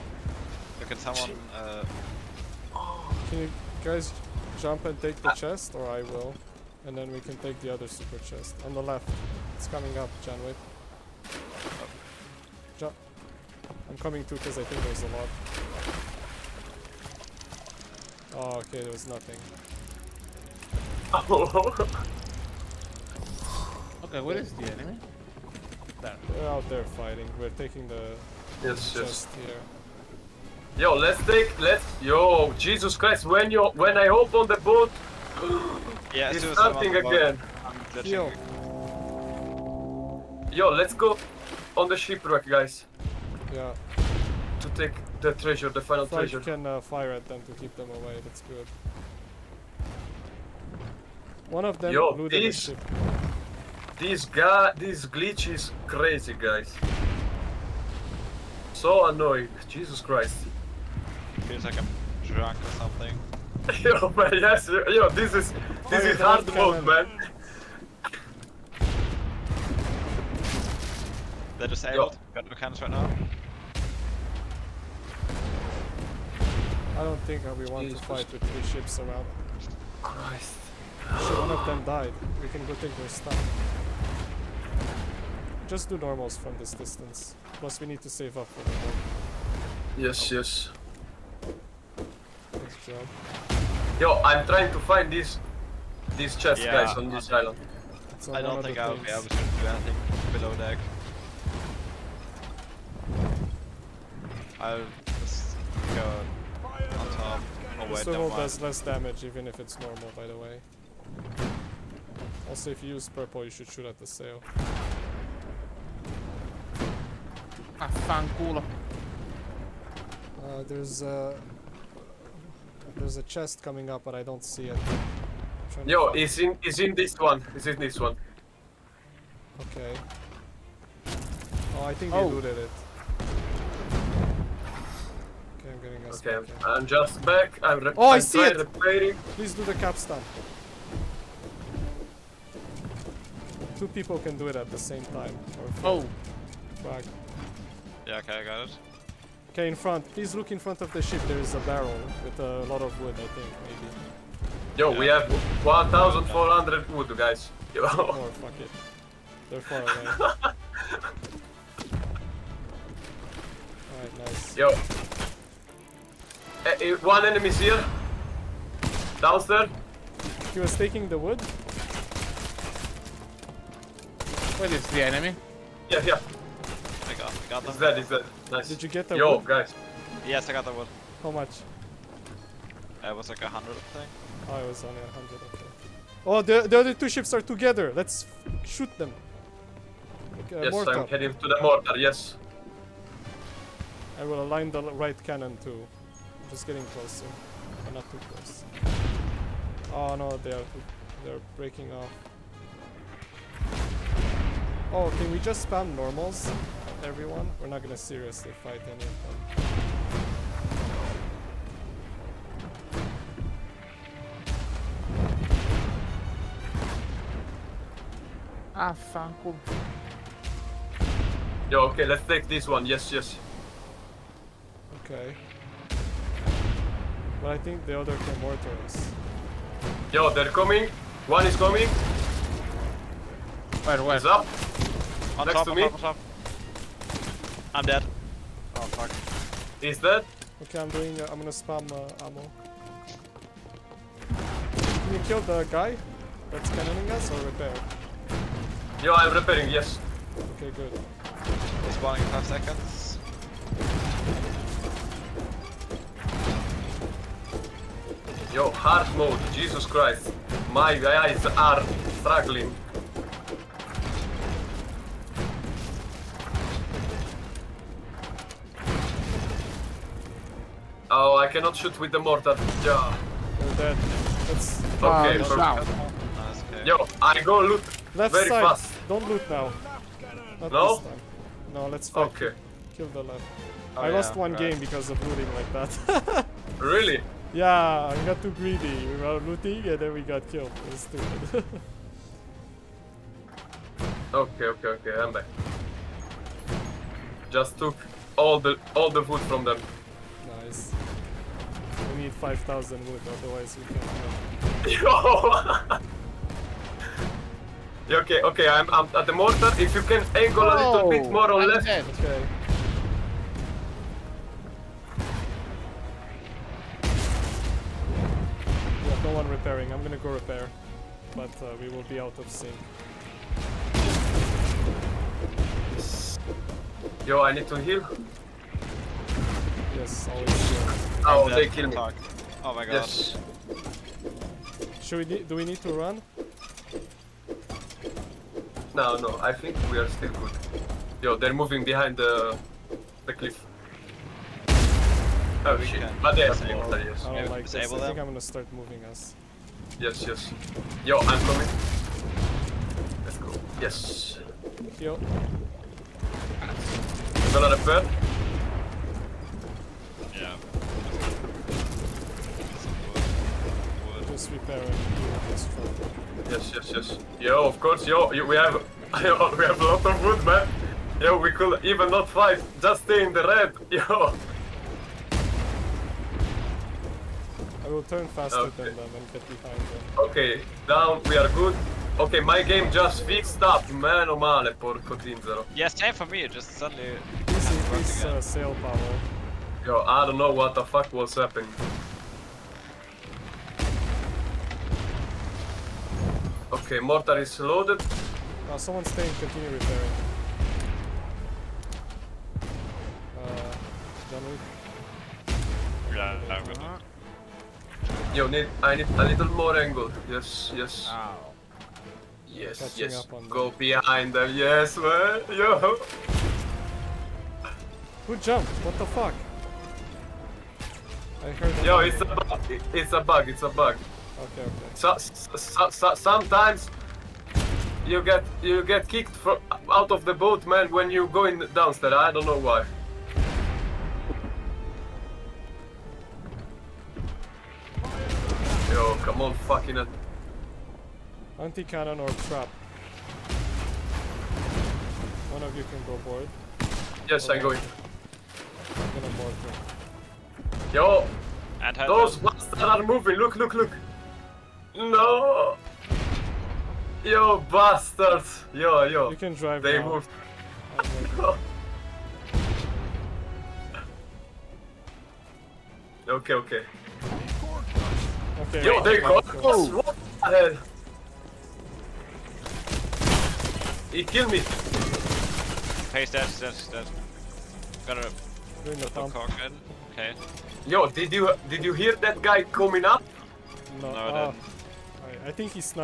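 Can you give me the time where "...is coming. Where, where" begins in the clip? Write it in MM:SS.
03:51.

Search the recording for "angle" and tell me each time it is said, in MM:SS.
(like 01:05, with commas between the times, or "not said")
05:10, 06:49.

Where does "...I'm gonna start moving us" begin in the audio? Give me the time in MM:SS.
05:48.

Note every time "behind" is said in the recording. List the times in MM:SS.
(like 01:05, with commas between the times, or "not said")
05:41, 06:19, 06:53.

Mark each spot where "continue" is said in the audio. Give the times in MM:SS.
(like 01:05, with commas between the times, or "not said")
06:39.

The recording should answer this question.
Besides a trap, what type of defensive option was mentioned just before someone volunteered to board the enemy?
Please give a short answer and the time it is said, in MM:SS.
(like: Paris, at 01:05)
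anti-cannon, at 07:21.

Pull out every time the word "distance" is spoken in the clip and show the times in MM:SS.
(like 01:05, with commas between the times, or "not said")
01:26.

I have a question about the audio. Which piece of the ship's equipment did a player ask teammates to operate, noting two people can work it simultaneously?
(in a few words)
capstan.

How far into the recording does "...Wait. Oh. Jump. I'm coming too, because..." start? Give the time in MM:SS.
00:10.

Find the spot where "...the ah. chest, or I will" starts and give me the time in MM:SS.
00:05.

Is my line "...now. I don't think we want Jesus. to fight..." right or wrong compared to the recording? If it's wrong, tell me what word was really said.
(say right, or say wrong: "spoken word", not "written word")
right.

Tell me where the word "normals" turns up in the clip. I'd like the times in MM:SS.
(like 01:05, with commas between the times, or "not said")
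01:25, 01:49, 03:25.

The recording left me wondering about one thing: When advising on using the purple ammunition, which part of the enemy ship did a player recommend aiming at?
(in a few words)
the sail.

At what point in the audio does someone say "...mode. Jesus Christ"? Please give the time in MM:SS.
04:19.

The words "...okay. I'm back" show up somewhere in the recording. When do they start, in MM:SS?
04:54.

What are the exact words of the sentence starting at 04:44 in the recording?
game because of looting like that.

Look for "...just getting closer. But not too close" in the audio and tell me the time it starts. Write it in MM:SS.
03:16.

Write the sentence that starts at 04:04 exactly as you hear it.
Can you kill the guy that's cannoning us or repair?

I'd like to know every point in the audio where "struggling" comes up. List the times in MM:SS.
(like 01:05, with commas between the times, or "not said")
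04:22.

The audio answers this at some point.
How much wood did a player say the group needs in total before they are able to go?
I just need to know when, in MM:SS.
05:02.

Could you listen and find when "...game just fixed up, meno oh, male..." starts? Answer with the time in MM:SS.
06:22.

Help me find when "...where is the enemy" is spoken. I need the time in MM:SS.
00:24.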